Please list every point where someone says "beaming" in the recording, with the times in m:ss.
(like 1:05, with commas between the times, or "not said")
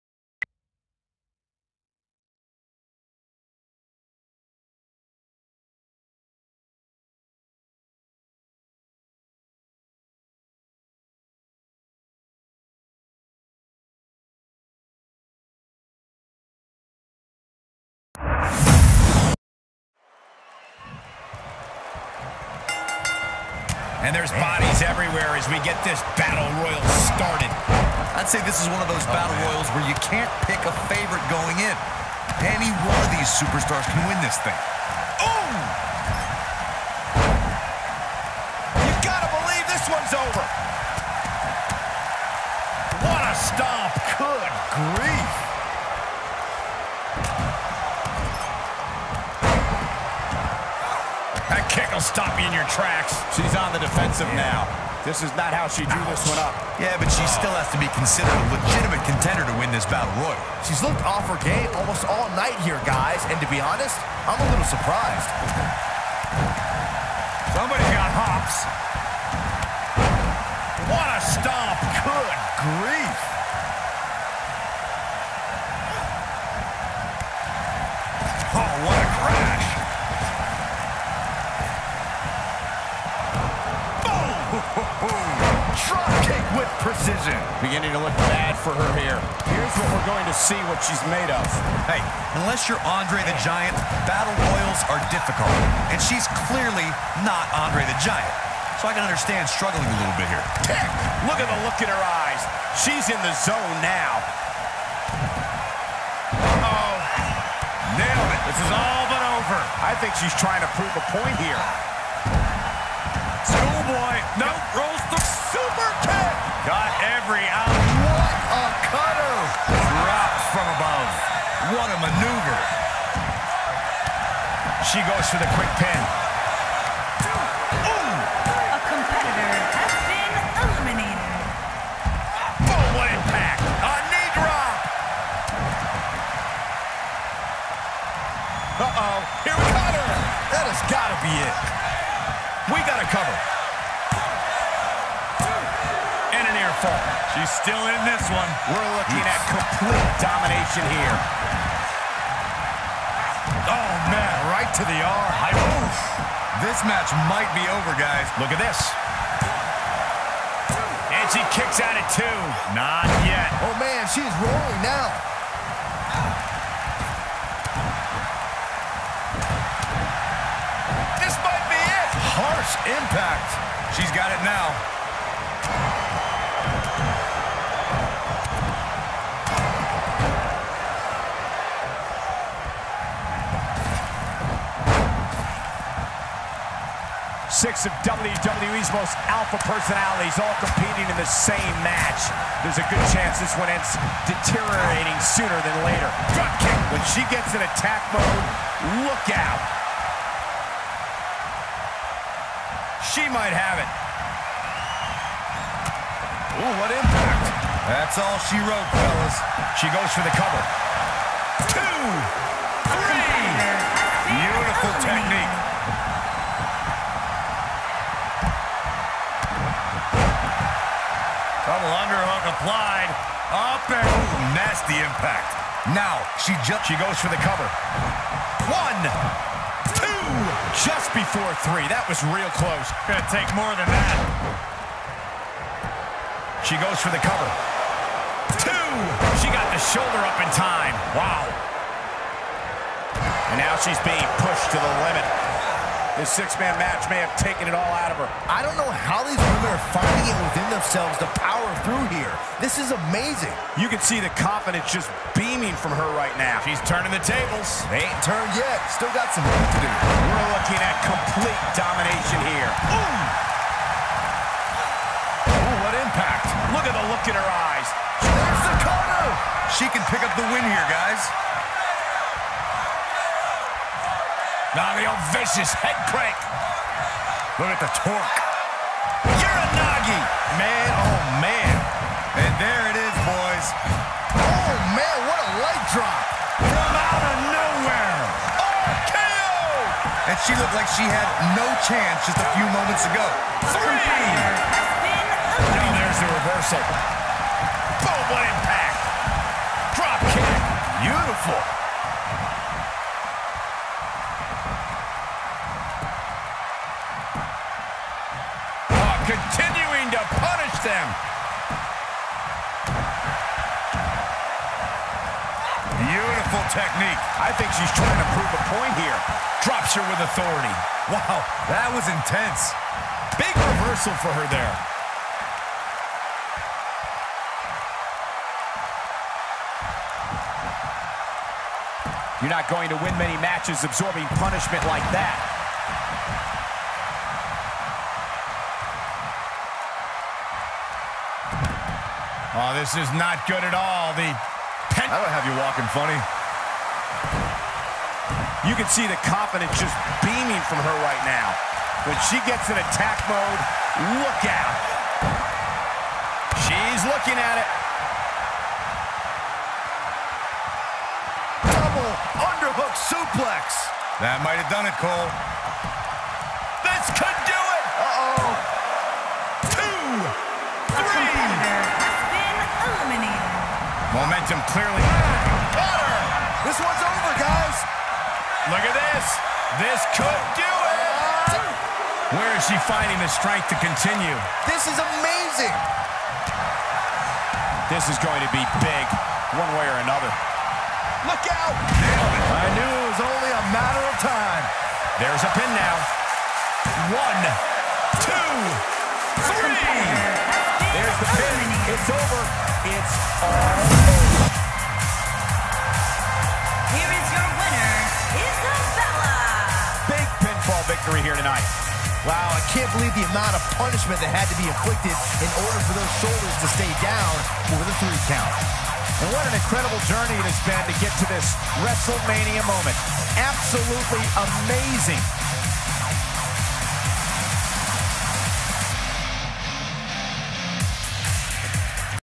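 4:15, 5:50.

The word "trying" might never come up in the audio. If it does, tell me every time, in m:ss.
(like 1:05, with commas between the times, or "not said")
1:50, 5:17.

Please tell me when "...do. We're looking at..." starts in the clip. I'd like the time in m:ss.
4:19.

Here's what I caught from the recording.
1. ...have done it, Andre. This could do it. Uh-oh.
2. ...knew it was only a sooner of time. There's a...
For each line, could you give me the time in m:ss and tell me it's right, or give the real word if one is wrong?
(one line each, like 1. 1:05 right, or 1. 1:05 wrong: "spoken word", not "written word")
1. 6:04 wrong: "Cole", not "Andre"
2. 6:32 wrong: "matter", not "sooner".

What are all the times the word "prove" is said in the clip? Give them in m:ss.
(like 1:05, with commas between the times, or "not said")
1:50, 5:18.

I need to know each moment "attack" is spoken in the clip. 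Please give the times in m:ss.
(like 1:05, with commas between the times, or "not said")
3:17, 5:52.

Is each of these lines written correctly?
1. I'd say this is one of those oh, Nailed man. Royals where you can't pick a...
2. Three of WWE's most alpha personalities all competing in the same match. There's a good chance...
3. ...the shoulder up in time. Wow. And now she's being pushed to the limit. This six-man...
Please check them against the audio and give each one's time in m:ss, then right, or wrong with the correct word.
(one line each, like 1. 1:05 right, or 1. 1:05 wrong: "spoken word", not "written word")
1. 0:28 wrong: "Battle", not "Nailed"
2. 3:07 wrong: "Six", not "Three"
3. 3:59 right.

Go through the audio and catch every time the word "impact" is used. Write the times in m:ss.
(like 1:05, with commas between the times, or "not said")
2:13, 2:52, 3:26, 3:45, 4:25.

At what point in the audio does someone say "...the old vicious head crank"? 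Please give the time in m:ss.
4:34.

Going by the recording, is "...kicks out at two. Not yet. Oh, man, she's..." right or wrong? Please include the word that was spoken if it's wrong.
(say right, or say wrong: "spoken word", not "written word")
right.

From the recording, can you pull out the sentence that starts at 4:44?
Oh man, what a light drop.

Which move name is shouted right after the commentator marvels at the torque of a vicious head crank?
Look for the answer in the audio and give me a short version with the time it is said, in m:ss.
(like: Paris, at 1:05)
Uranage, at 4:39.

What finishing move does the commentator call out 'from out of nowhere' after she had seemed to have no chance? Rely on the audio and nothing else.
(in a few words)
RKO.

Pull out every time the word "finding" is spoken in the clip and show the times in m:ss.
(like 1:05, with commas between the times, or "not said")
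4:09, 6:22.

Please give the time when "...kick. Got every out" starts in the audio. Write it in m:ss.
1:56.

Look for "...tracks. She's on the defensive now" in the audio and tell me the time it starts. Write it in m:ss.
0:52.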